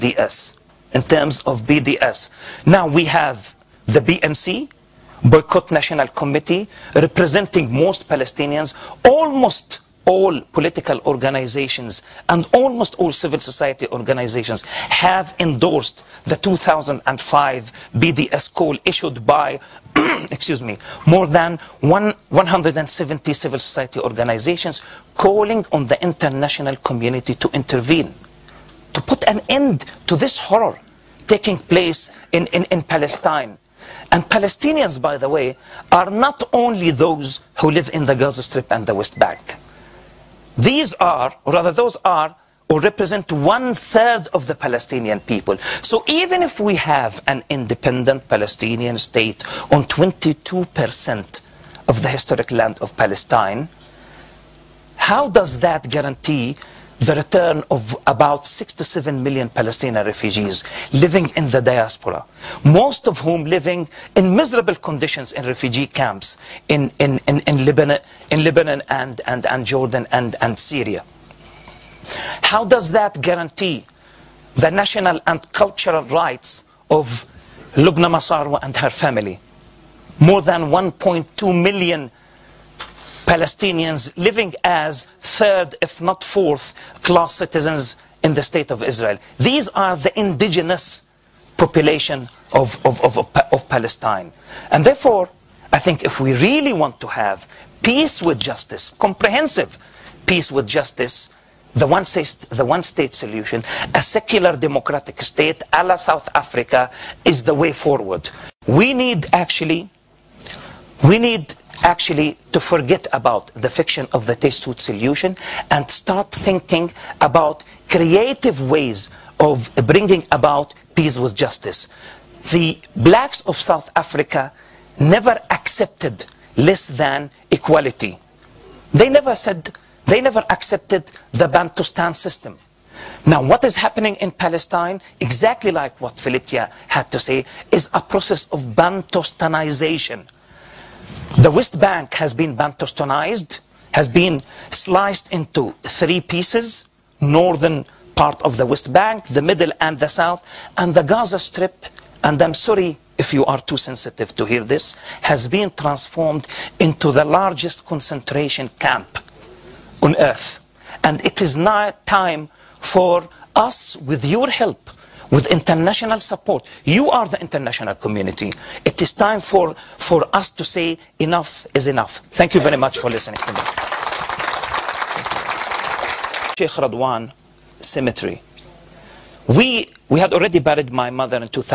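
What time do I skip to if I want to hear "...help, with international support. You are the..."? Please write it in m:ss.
2:44.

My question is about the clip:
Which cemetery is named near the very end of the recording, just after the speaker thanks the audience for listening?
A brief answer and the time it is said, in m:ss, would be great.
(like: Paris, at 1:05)
Sheikh Radwan Cemetery, at 2:56.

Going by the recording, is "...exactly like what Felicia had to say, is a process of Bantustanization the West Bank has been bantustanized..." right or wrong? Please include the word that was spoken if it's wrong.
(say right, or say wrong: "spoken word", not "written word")
right.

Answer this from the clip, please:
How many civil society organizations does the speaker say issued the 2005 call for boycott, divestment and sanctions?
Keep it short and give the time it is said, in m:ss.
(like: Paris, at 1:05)
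170, at 0:22.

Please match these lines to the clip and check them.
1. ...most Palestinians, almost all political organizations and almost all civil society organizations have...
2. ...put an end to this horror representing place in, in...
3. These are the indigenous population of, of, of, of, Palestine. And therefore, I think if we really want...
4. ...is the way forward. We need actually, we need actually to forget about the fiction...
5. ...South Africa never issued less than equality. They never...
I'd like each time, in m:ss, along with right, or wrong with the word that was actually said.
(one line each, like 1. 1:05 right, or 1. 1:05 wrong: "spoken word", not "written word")
1. 0:07 right
2. 0:29 wrong: "taking", not "representing"
3. 1:29 right
4. 1:47 right
5. 2:03 wrong: "accepted", not "issued".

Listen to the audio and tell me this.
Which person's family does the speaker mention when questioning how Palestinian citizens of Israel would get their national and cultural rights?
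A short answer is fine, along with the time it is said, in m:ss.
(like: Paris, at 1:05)
Lubna Masarwa, at 1:17.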